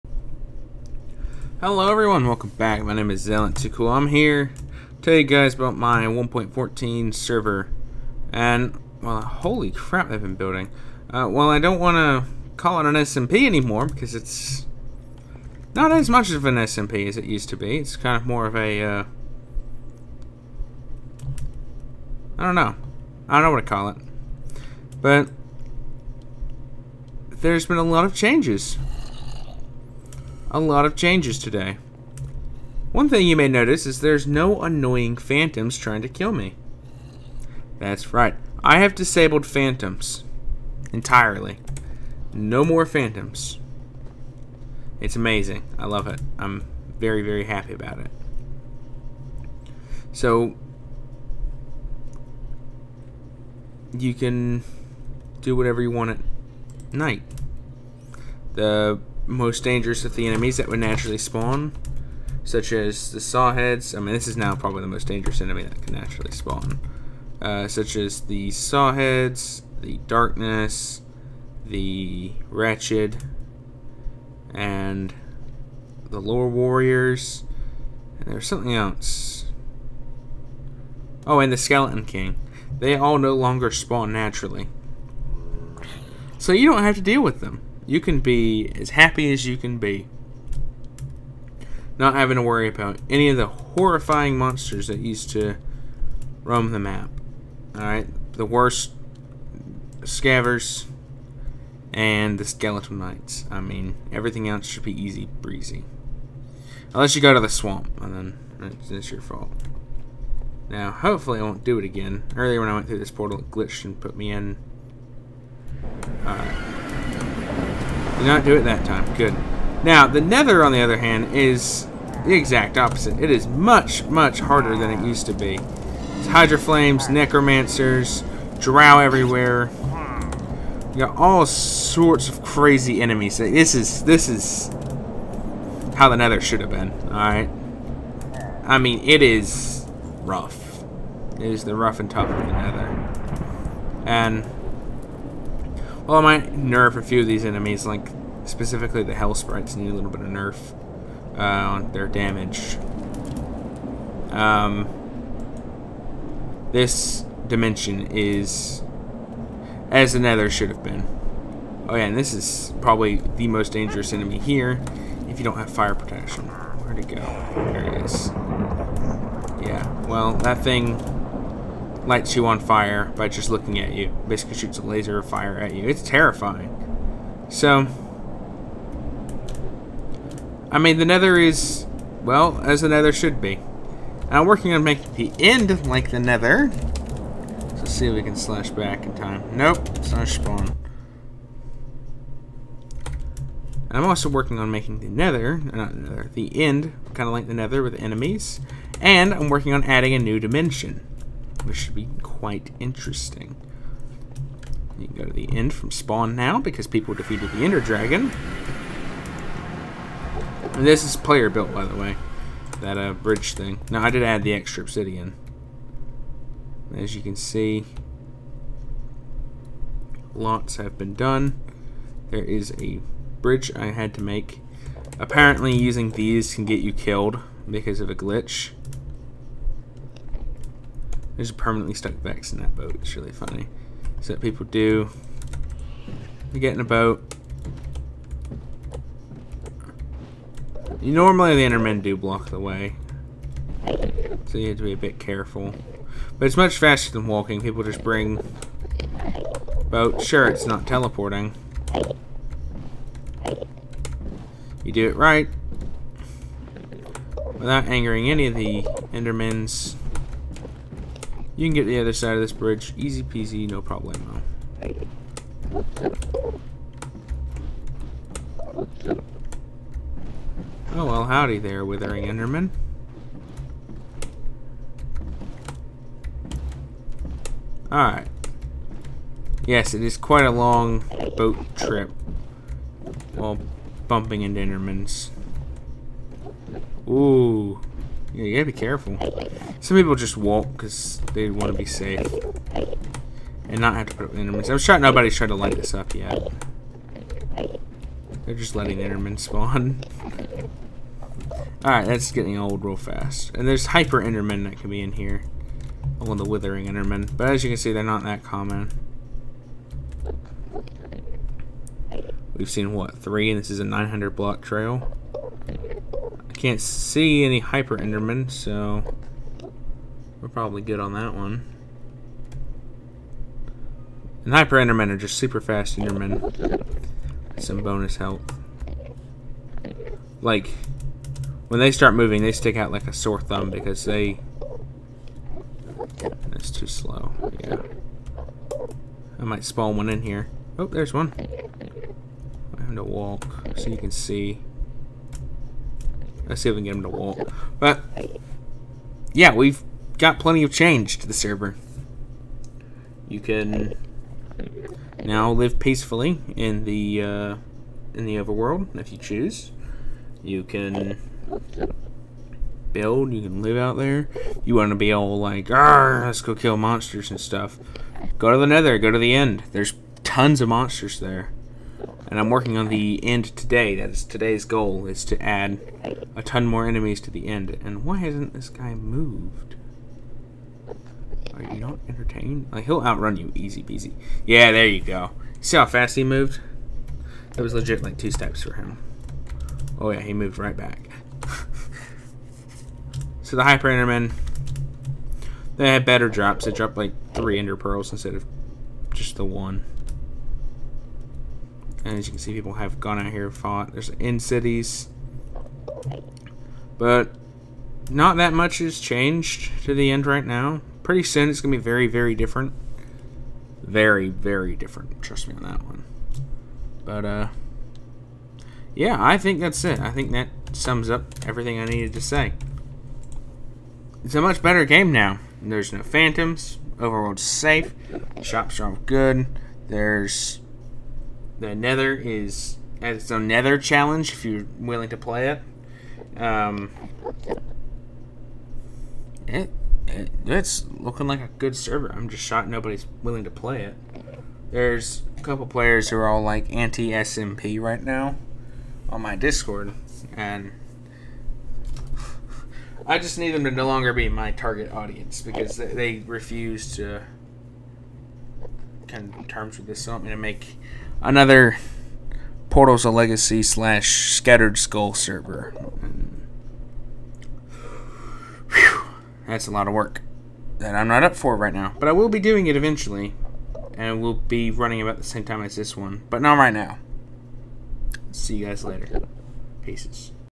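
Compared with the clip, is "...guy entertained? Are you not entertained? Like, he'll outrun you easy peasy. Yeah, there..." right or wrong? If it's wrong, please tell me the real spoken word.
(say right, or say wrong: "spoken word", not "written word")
wrong: "moved", not "entertained".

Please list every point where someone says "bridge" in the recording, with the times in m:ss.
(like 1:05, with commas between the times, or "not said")
3:33, 3:43, 4:22.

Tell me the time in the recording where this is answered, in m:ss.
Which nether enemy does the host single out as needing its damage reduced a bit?
2:29.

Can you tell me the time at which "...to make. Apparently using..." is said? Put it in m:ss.
3:44.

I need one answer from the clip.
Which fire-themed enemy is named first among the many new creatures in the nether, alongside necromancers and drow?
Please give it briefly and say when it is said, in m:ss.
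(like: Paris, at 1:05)
Hydra Flames, at 2:06.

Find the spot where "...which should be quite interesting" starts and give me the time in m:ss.
3:21.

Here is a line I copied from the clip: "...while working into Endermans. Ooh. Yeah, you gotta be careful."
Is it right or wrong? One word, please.
wrong.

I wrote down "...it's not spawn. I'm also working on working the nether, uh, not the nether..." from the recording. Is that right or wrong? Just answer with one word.
wrong.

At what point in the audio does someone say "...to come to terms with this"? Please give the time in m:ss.
7:36.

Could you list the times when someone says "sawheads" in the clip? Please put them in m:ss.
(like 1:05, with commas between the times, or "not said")
1:03, 1:08.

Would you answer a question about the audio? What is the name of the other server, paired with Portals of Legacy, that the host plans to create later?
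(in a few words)
Scattered Skull.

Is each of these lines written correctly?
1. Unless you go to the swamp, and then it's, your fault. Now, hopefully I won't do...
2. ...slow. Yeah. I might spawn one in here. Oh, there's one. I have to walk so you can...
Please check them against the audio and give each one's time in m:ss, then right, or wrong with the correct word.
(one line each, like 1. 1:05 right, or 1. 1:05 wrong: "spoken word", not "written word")
1. 1:46 right
2. 5:36 right.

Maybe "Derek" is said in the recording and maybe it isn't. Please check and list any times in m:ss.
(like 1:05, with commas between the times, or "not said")
not said.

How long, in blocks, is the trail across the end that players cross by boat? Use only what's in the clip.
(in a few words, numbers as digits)
900.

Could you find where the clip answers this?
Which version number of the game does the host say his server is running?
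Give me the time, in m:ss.
0:06.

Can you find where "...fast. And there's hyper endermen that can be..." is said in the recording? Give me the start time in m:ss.
5:02.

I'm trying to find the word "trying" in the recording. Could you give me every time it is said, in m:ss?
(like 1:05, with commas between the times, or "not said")
0:35, 4:55.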